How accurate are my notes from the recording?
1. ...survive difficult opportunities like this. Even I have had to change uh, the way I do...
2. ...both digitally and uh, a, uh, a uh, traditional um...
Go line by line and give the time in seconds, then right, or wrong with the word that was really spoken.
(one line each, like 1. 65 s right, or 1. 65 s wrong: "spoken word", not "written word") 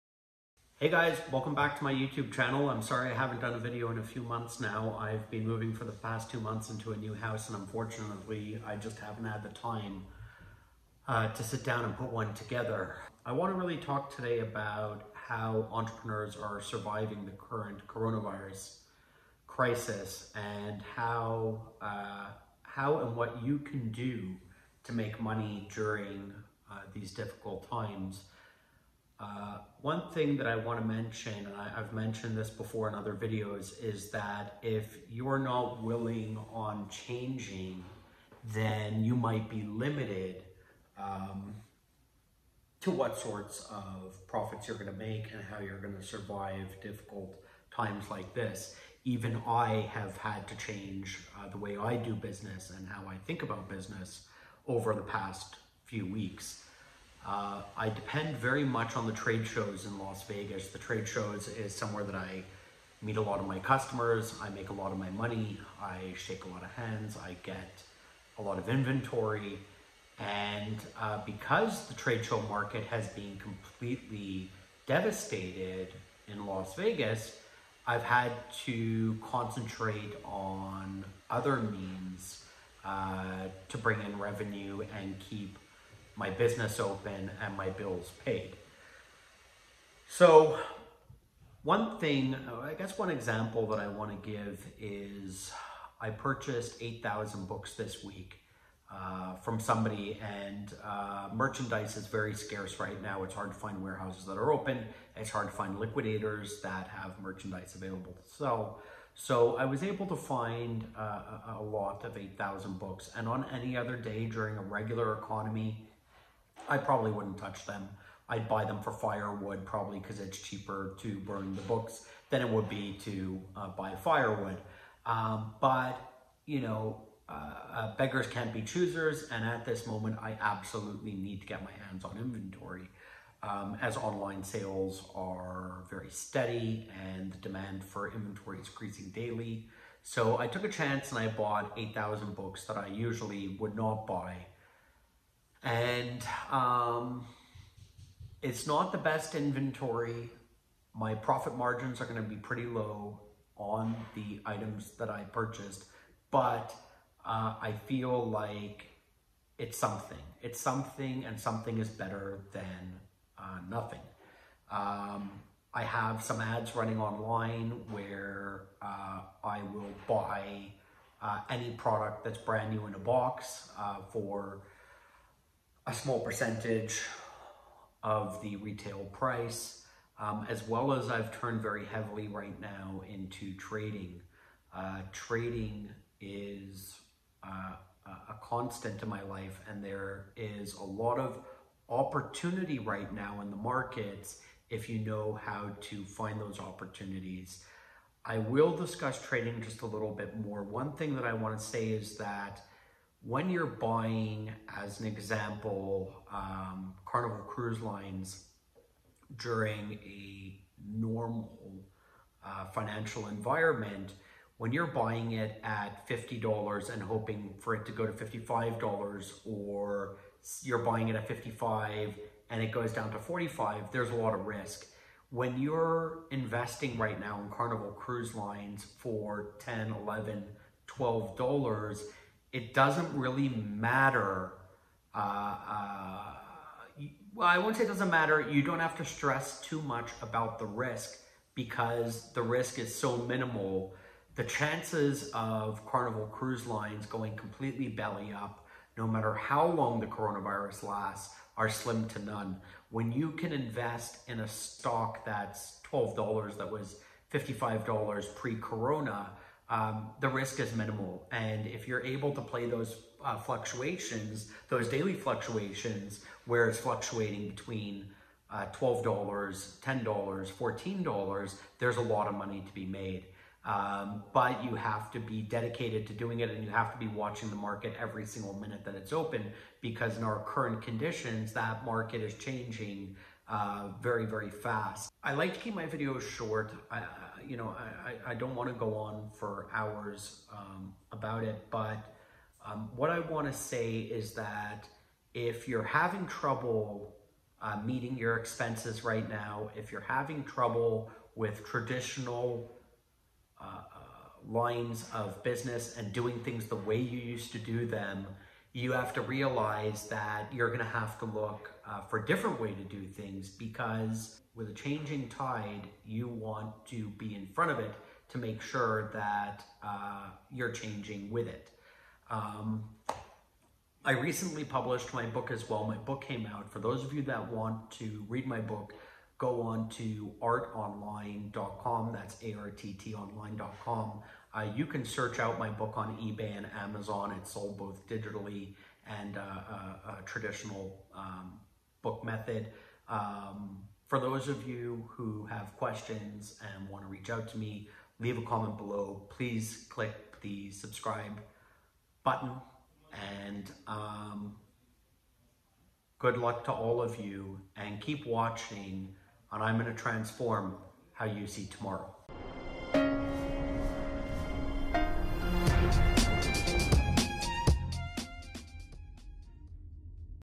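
1. 46 s wrong: "times", not "opportunities"
2. 337 s right.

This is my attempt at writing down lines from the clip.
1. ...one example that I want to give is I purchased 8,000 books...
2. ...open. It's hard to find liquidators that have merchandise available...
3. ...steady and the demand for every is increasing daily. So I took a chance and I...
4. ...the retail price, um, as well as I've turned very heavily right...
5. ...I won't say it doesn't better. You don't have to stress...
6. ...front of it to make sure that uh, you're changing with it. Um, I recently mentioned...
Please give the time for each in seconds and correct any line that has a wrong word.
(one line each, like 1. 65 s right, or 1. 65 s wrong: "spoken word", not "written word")
1. 92 s right
2. 104 s right
3. 136 s wrong: "inventory", not "every"
4. 178 s right
5. 237 s wrong: "matter", not "better"
6. 317 s wrong: "published", not "mentioned".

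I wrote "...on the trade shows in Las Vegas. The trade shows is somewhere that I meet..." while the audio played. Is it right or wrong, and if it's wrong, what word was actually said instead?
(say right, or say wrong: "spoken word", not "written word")
right.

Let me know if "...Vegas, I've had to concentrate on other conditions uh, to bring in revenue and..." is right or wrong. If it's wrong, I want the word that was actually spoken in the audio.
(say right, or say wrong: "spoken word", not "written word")
wrong: "means", not "conditions".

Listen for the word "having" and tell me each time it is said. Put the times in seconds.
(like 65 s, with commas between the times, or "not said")
295 s, 300 s.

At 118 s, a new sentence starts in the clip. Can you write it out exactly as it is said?
I'd buy them for firewood probably because it's cheaper to burn the books than it would be to uh, buy firewood.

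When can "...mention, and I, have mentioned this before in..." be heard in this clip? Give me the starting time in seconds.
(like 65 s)
30 s.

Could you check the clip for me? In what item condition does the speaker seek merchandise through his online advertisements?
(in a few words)
brand new in a box.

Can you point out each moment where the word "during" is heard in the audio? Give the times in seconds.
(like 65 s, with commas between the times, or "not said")
25 s, 114 s, 209 s.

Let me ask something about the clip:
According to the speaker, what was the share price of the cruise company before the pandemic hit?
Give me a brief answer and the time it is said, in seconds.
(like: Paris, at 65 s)
$55, at 257 s.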